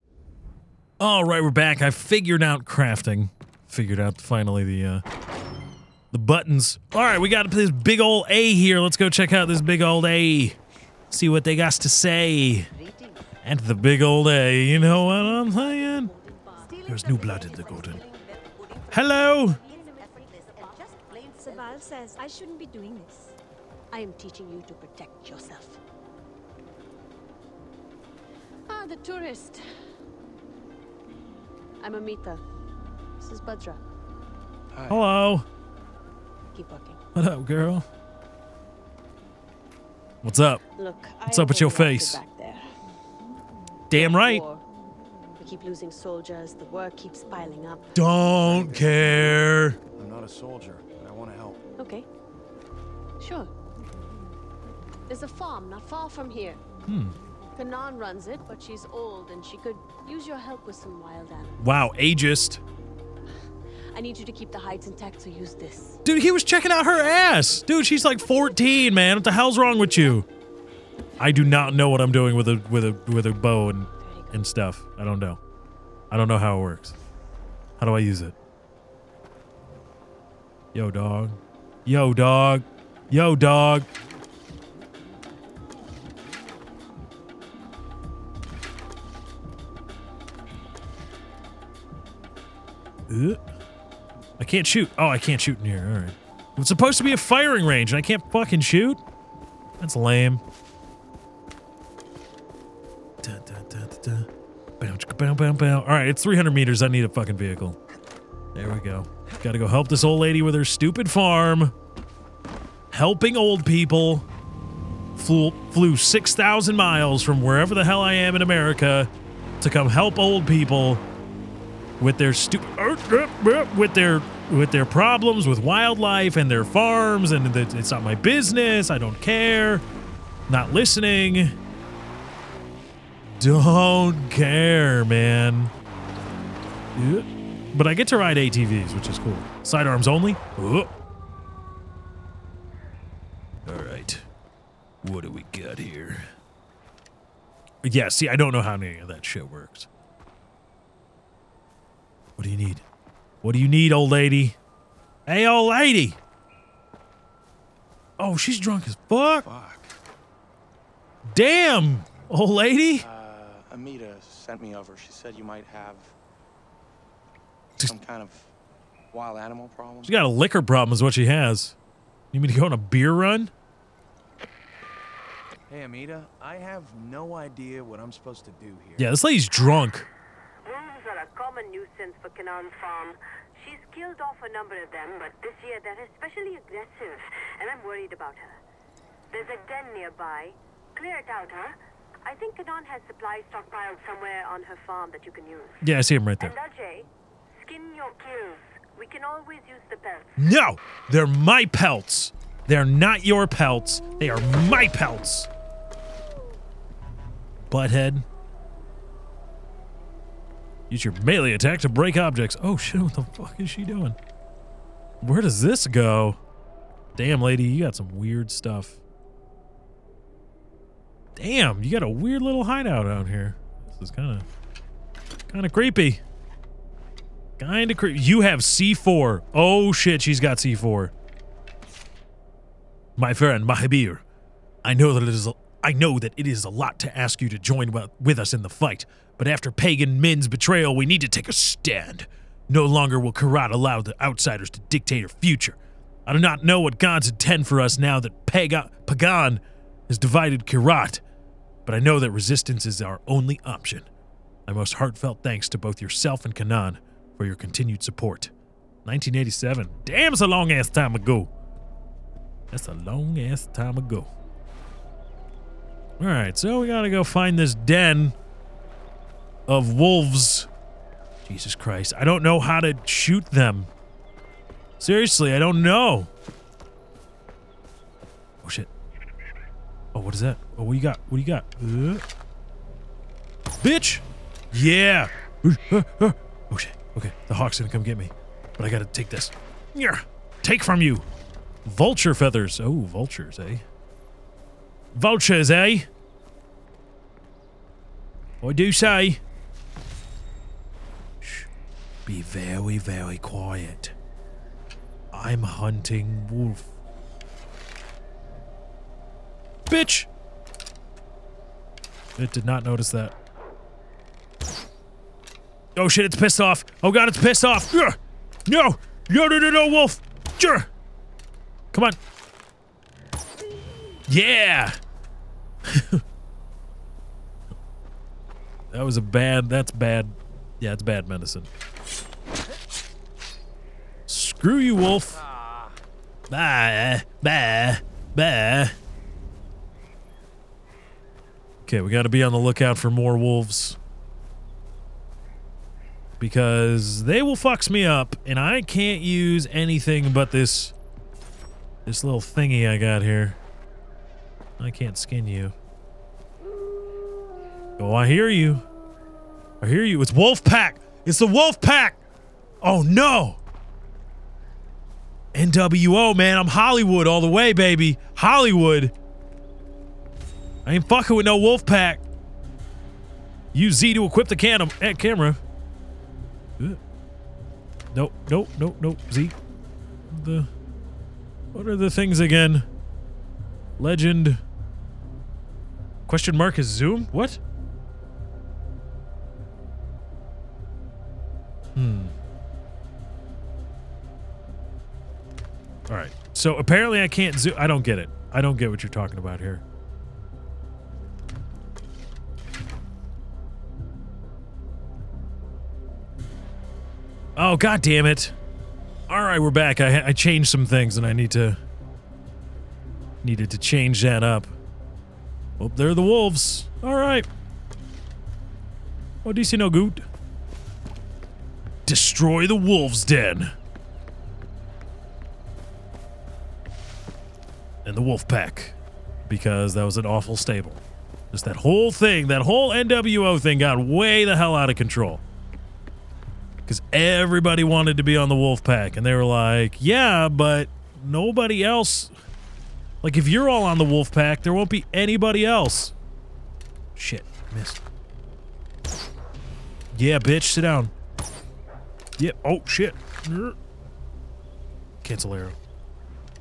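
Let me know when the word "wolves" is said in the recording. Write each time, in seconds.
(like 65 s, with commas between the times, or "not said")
269 s, 343 s, 416 s, 422 s.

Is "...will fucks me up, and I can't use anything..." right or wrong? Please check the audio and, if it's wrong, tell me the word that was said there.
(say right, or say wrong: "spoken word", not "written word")
right.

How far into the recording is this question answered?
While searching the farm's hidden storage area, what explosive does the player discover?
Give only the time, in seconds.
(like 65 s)
228 s.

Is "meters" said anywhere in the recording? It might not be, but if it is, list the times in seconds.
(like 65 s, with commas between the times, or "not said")
106 s.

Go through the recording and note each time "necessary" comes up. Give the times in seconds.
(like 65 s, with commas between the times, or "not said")
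not said.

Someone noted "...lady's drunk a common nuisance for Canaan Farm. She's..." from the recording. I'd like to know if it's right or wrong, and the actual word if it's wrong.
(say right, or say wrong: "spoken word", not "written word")
right.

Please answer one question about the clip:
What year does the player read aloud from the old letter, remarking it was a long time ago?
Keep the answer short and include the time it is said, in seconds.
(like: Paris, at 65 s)
1987, at 259 s.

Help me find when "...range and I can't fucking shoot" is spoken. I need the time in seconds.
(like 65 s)
97 s.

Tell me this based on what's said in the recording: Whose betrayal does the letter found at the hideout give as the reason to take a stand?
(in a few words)
Pagan Min.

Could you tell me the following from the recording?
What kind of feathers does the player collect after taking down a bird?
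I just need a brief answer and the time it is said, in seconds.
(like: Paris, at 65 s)
Vulture feathers, at 291 s.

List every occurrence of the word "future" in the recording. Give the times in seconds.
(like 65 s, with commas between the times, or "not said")
245 s.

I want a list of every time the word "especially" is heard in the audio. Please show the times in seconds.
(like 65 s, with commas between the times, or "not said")
186 s.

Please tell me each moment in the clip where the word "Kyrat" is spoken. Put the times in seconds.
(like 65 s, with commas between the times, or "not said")
243 s, 250 s.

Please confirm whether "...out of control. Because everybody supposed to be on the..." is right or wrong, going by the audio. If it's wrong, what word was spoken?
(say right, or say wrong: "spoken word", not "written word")
wrong: "wanted", not "supposed".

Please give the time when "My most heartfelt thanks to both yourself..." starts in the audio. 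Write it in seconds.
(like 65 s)
254 s.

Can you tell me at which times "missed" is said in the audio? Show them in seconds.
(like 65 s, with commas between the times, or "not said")
447 s.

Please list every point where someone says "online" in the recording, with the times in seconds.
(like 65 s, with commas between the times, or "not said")
not said.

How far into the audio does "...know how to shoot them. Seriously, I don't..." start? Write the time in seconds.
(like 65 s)
272 s.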